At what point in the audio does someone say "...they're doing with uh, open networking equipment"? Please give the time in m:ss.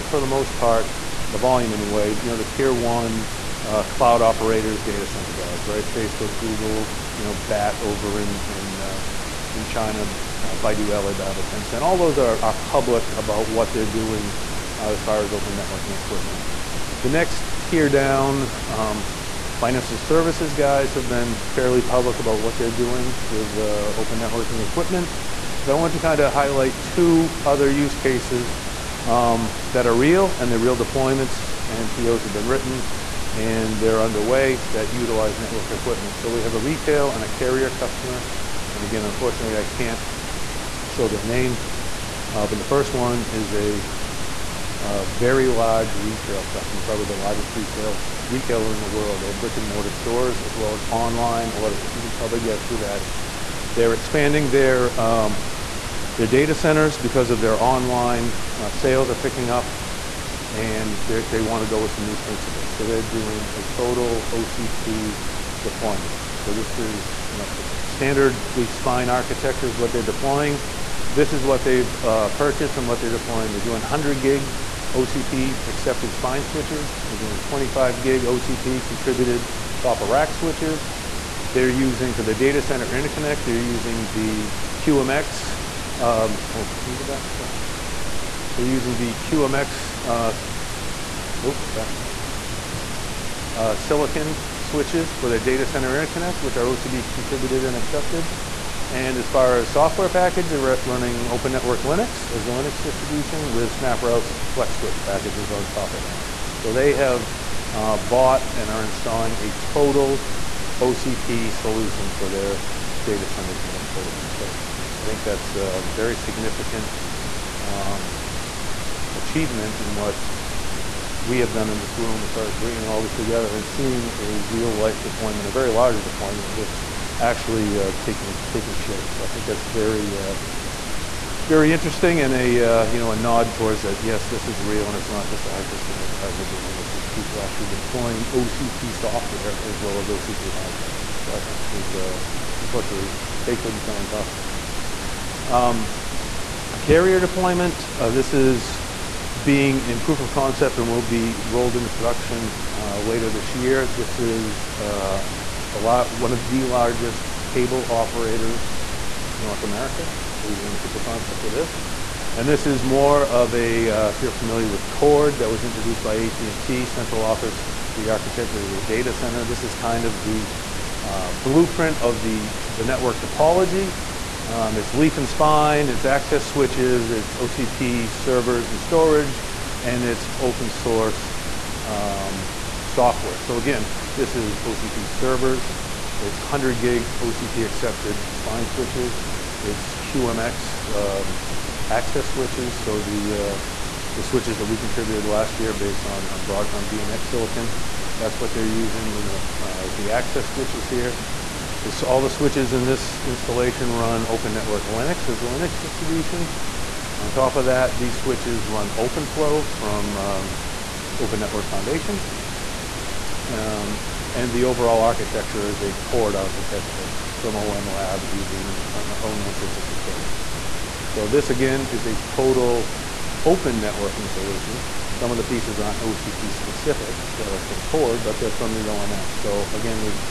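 0:22.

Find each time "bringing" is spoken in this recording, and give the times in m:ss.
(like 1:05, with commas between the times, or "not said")
2:02.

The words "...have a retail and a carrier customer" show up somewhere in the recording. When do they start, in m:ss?
0:36.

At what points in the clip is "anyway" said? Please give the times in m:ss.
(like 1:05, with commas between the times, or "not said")
0:01.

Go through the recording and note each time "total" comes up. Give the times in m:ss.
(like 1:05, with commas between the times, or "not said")
1:03, 1:49, 3:42.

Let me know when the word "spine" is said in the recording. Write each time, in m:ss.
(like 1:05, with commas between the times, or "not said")
1:08, 1:16, 2:55, 3:08.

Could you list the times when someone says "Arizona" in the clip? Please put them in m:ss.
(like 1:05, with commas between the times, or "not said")
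not said.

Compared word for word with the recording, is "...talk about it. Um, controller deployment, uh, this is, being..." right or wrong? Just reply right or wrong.
wrong.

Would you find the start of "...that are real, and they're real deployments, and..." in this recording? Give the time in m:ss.
0:29.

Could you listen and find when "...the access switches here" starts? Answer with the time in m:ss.
3:19.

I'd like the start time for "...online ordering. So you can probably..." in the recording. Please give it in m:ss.
0:50.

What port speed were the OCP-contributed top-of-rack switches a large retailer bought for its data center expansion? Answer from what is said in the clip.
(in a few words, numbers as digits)
25 gig.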